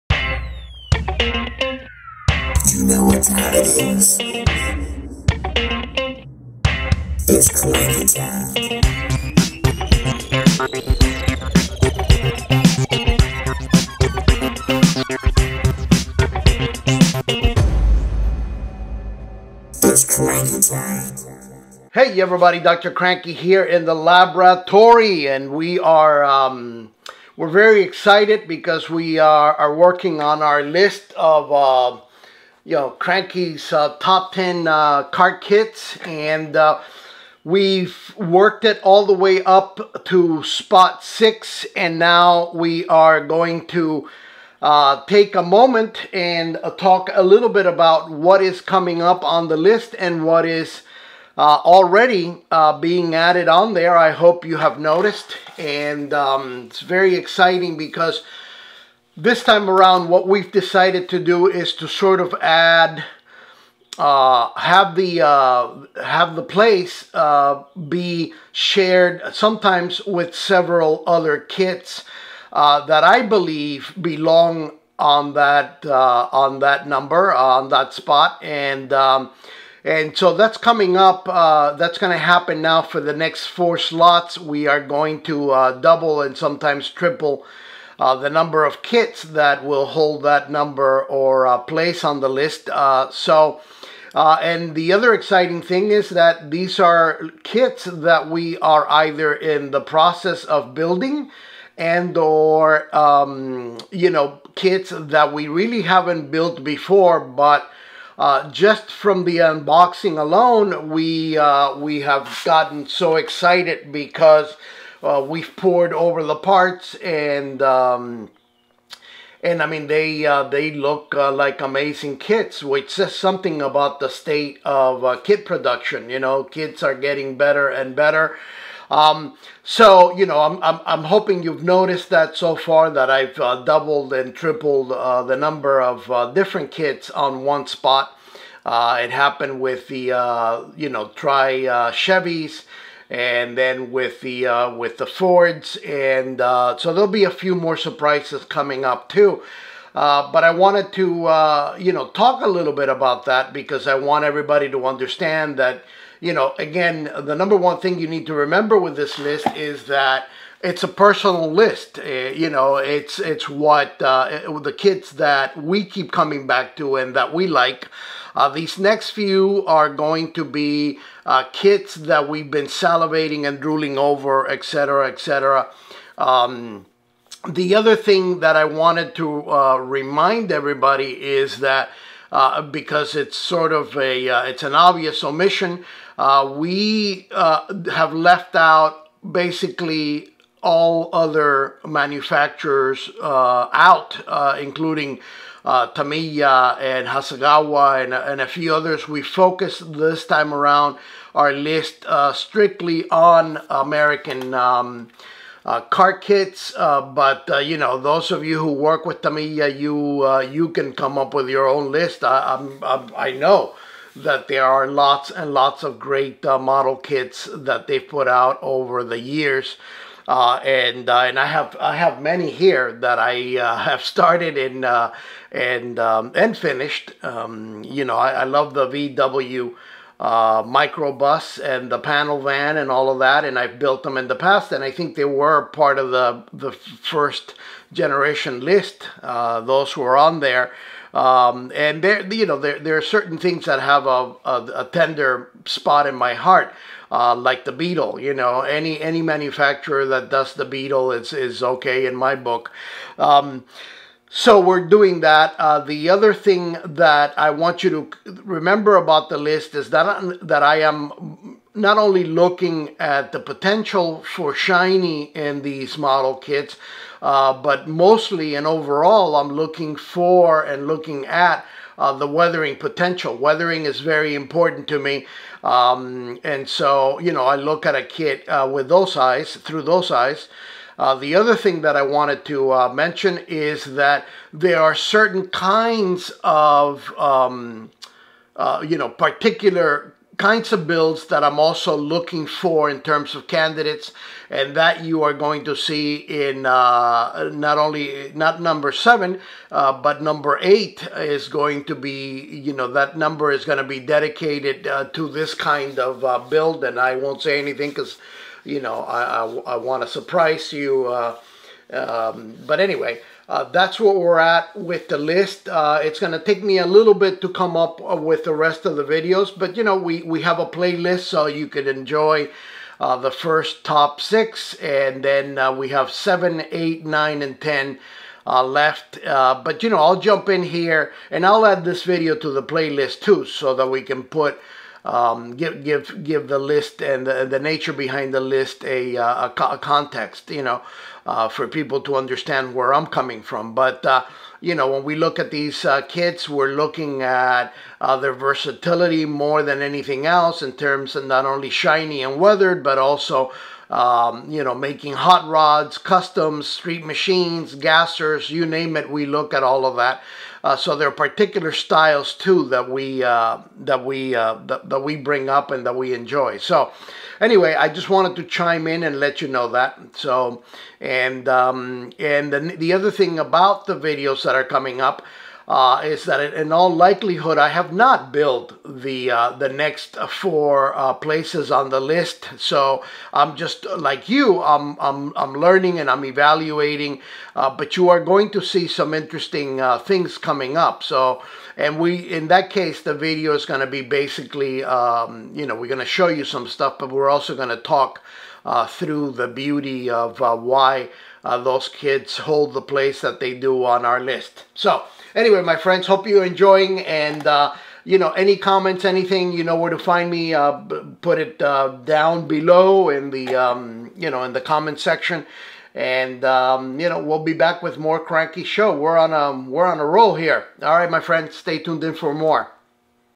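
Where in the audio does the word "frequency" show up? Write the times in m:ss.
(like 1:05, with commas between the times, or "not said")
not said.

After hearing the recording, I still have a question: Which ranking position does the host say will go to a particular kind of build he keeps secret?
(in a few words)
8.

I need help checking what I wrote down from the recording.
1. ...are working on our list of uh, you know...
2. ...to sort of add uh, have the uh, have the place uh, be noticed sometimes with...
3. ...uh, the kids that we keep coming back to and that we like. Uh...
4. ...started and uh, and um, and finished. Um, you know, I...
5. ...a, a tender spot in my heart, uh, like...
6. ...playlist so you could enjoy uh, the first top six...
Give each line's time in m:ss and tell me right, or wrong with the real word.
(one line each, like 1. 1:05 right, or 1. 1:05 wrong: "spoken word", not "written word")
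1. 0:29 right
2. 1:01 wrong: "shared", not "noticed"
3. 2:44 right
4. 3:44 right
5. 4:04 right
6. 5:20 right.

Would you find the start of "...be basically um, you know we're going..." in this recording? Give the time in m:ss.
6:33.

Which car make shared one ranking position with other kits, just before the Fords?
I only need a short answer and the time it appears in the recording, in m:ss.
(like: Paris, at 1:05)
Chevys, at 2:21.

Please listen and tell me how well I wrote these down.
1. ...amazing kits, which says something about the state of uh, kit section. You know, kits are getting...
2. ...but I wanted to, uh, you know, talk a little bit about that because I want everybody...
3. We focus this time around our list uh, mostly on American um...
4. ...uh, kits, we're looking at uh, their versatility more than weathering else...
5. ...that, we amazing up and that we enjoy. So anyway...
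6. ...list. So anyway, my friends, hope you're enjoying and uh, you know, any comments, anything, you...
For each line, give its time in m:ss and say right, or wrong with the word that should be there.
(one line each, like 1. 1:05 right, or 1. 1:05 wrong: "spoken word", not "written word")
1. 2:01 wrong: "production", not "section"
2. 2:30 right
3. 3:19 wrong: "strictly", not "mostly"
4. 5:45 wrong: "anything", not "weathering"
5. 6:04 wrong: "bring", not "amazing"
6. 6:44 right.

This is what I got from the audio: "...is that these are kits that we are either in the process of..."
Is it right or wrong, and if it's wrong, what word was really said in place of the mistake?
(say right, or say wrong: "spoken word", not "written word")
right.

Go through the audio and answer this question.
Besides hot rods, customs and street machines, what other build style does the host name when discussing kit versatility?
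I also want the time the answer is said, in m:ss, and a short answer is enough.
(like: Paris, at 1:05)
Gassers, at 5:57.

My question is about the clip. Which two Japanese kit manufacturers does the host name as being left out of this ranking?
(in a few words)
Tamiya and Hasegawa.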